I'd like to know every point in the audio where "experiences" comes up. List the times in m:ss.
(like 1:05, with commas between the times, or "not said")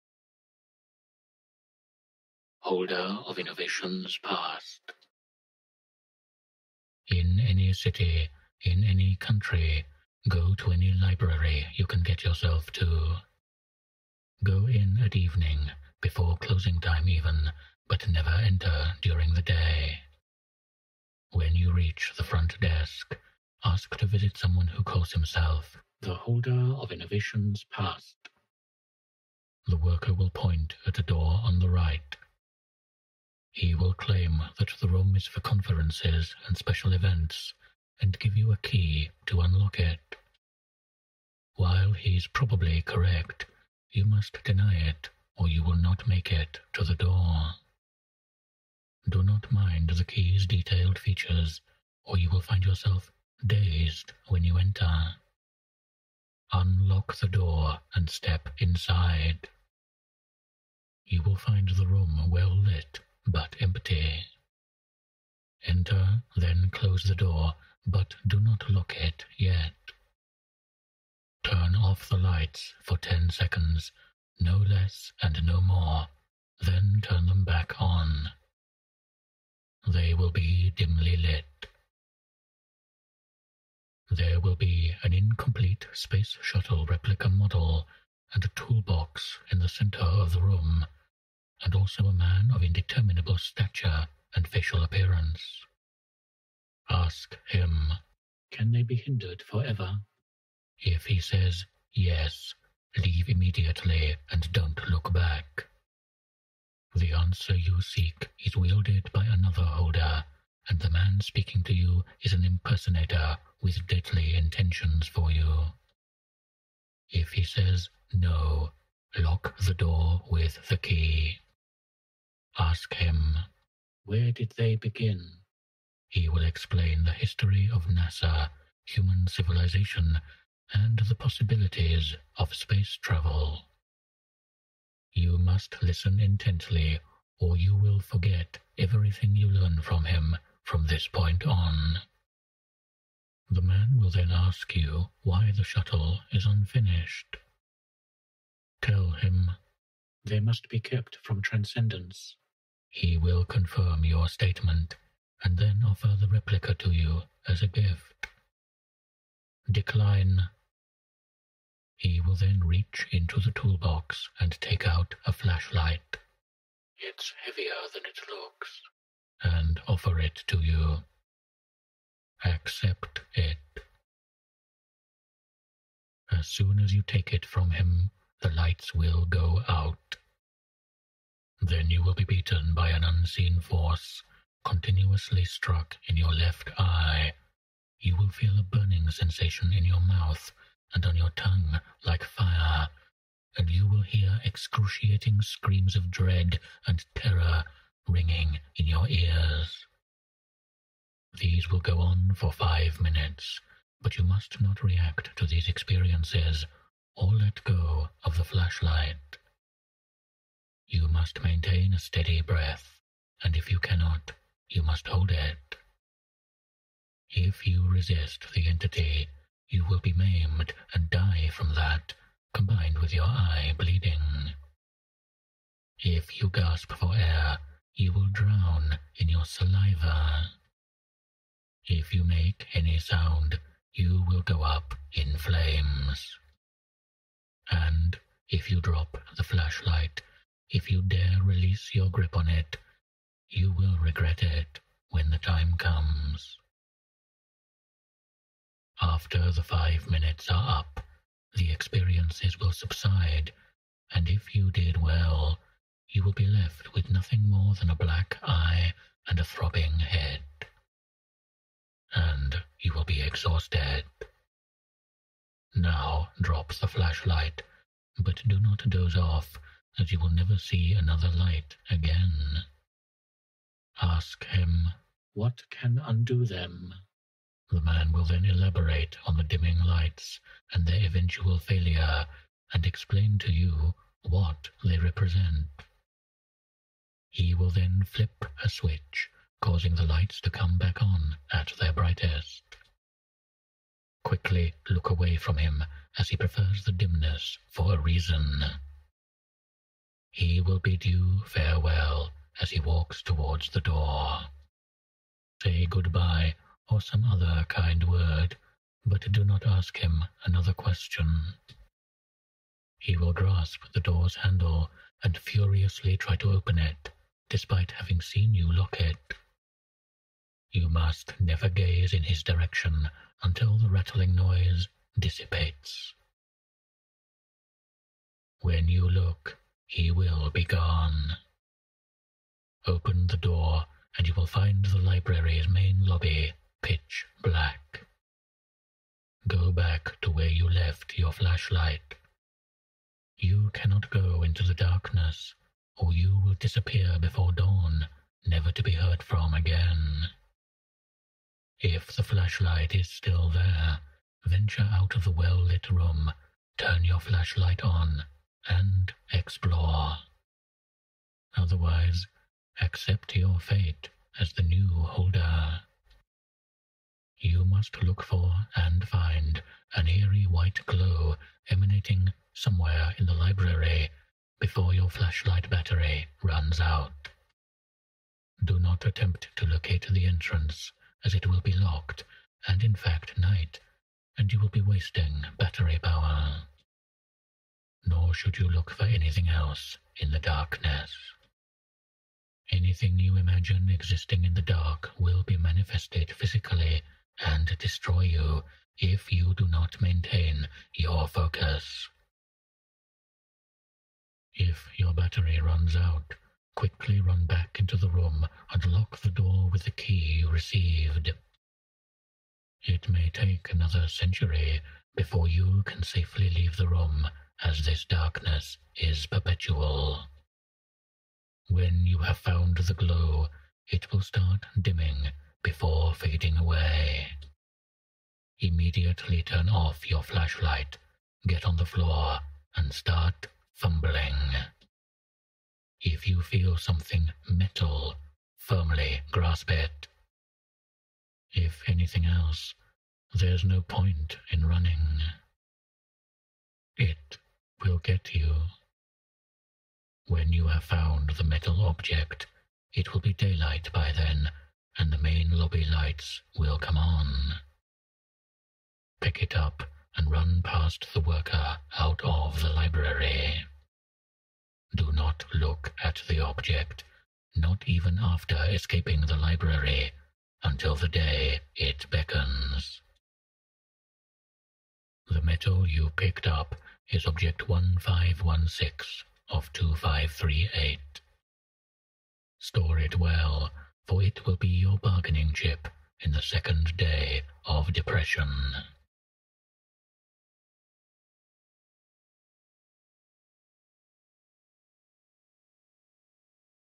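3:25, 4:11.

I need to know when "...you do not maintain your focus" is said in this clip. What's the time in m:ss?
6:39.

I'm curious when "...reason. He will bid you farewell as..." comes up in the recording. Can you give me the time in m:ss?
4:57.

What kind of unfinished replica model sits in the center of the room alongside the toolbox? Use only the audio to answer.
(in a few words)
Space shuttle.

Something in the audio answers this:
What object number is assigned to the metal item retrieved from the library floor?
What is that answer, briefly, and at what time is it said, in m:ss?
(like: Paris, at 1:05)
1516, at 7:57.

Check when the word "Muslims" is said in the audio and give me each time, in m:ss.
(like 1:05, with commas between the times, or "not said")
not said.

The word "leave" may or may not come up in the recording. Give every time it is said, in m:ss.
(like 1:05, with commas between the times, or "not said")
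1:42, 6:56.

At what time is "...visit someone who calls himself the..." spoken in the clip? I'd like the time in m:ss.
0:24.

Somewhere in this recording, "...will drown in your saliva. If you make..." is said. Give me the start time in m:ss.
3:48.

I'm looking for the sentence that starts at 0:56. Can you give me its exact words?
Unlock the door and step inside.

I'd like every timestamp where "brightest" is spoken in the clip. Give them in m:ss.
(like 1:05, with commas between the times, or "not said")
4:51.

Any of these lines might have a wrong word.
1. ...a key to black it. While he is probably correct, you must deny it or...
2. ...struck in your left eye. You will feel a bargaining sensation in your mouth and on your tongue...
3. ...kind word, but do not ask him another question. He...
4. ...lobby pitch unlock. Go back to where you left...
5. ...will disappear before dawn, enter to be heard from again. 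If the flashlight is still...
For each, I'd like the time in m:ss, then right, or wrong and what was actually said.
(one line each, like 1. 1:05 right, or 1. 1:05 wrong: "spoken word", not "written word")
1. 0:38 wrong: "unlock", not "black"
2. 3:05 wrong: "burning", not "bargaining"
3. 5:07 right
4. 5:36 wrong: "black", not "unlock"
5. 5:46 wrong: "never", not "enter".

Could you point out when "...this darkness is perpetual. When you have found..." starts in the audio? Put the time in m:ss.
6:57.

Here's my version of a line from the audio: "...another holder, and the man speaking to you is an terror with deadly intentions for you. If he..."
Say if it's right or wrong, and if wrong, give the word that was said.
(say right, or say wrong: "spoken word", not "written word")
wrong: "impersonator", not "terror".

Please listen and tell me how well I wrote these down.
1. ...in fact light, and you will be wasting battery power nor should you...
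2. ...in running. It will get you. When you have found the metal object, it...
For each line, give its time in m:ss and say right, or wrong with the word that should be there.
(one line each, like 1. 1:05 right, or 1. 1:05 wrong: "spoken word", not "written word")
1. 6:22 wrong: "night", not "light"
2. 7:24 right.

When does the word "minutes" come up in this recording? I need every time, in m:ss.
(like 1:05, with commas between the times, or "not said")
3:22, 4:10.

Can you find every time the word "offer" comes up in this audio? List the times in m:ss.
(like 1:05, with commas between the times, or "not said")
2:35, 2:49.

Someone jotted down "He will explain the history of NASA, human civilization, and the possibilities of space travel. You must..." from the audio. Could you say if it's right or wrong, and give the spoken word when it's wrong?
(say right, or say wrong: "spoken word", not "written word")
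right.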